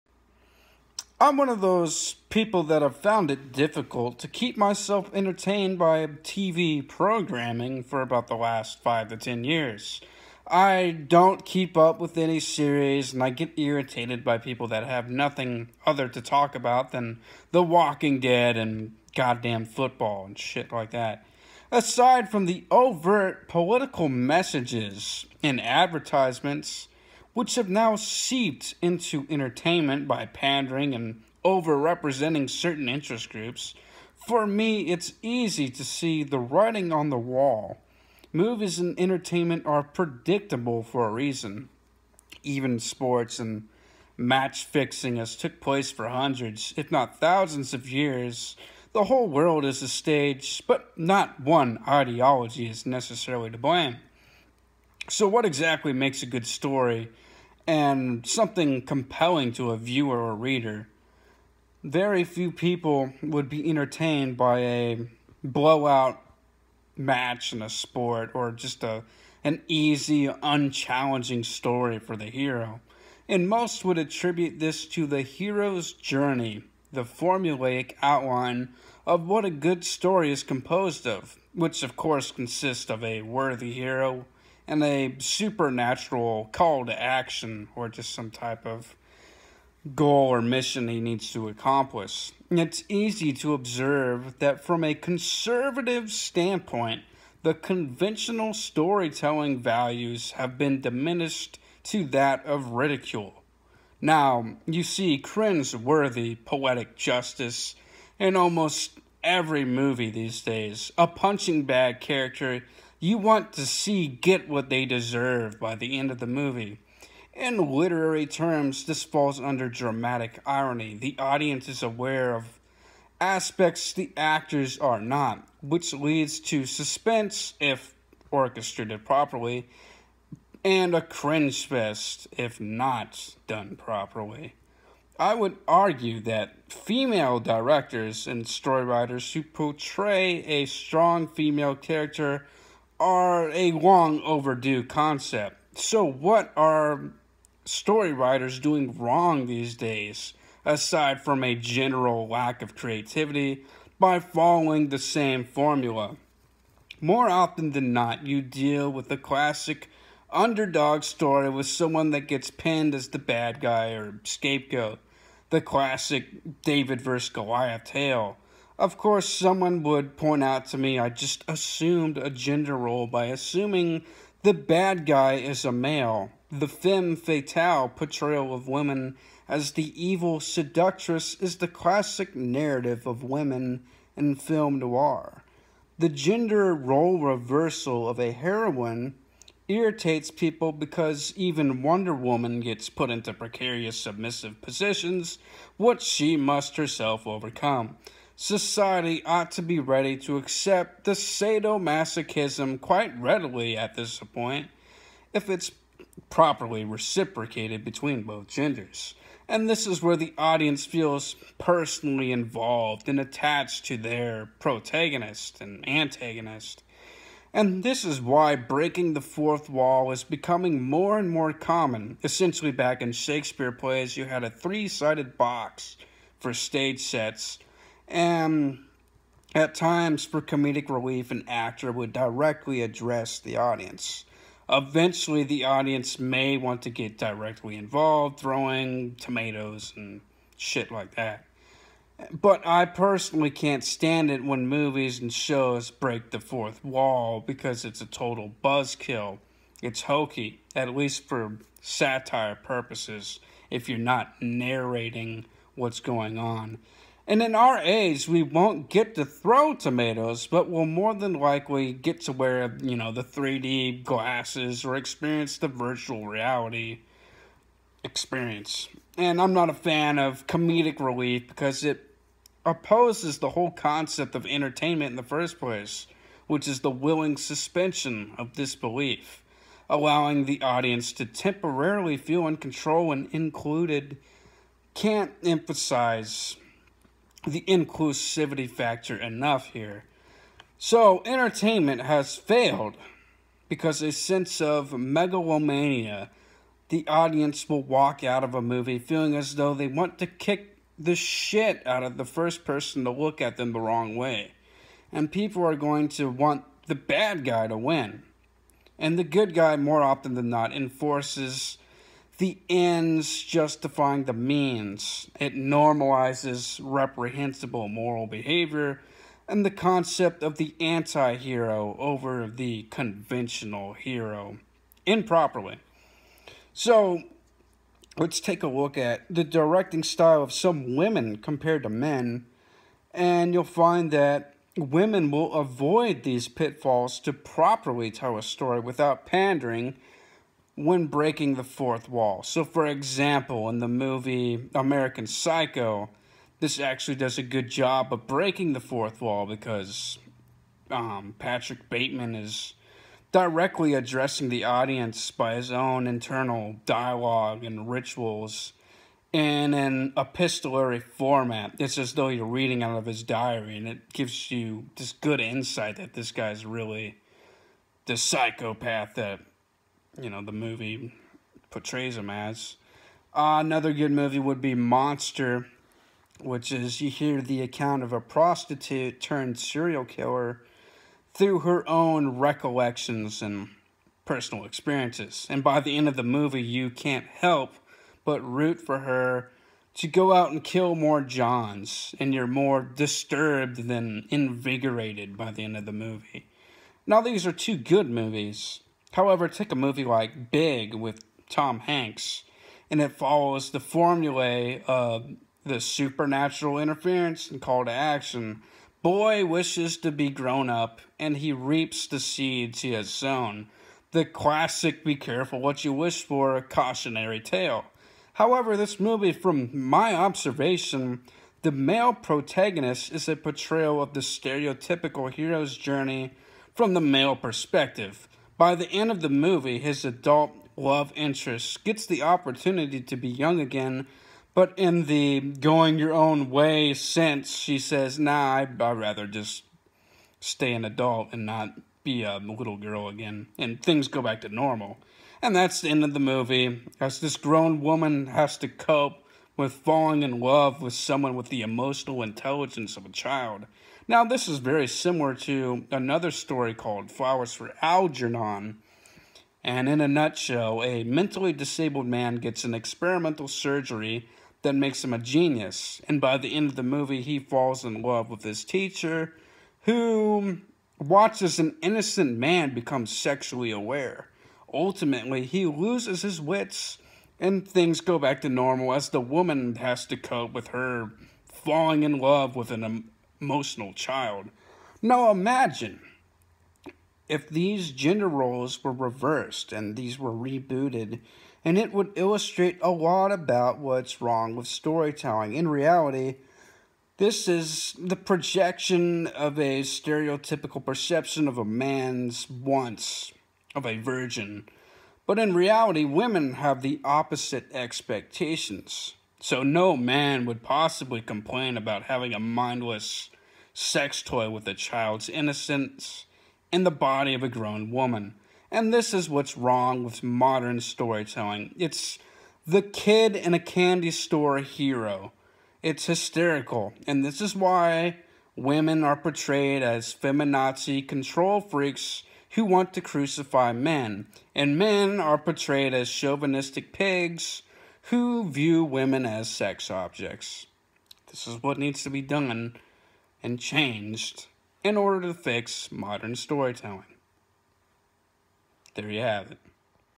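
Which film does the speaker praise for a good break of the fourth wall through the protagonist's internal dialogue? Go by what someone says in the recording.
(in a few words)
American Psycho.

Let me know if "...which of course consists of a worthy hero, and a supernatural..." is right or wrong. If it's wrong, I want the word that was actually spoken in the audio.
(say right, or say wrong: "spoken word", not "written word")
right.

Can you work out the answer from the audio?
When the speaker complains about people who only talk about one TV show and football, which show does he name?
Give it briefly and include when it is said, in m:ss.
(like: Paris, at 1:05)
The Walking Dead, at 0:17.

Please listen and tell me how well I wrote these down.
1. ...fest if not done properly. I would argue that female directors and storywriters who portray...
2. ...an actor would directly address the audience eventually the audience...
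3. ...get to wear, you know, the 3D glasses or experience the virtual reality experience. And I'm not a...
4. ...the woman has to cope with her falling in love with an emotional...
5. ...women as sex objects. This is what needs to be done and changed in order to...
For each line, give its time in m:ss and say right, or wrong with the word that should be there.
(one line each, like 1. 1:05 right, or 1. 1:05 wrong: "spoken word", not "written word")
1. 2:11 right
2. 3:51 right
3. 4:21 right
4. 7:59 right
5. 8:58 right.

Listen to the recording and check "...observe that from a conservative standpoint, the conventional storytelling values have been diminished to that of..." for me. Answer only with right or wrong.
right.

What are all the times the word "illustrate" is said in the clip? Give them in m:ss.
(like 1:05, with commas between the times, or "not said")
8:12.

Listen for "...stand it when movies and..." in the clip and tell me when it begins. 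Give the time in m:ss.
4:03.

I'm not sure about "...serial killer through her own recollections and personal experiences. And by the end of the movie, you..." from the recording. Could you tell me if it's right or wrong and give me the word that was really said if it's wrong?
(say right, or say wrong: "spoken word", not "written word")
right.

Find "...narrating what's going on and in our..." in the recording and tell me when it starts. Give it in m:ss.
4:14.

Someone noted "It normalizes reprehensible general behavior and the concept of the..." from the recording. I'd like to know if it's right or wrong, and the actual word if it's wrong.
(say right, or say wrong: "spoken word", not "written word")
wrong: "moral", not "general".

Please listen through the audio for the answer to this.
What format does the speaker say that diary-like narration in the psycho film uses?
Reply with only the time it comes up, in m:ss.
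6:00.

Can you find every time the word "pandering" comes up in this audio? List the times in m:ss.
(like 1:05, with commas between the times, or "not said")
0:30, 5:39.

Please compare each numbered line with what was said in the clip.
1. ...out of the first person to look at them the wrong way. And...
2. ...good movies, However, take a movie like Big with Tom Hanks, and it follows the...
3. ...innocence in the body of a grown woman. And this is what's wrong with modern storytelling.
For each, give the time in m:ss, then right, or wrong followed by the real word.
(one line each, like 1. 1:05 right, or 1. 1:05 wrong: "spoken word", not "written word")
1. 5:01 right
2. 6:37 right
3. 8:35 right.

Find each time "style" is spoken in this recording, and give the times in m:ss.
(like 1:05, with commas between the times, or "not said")
5:30.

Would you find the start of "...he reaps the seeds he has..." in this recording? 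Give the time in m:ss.
6:51.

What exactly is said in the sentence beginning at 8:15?
In reality, this is the projection of a stereotypical perception of a man's wants of a virgin.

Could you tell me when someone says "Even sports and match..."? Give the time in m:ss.
0:42.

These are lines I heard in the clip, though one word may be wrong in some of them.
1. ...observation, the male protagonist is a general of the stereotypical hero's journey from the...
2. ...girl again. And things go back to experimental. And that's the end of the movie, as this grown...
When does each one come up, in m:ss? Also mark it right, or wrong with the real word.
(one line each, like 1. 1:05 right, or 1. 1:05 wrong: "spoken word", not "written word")
1. 7:00 wrong: "portrayal", not "general"
2. 7:22 wrong: "normal", not "experimental".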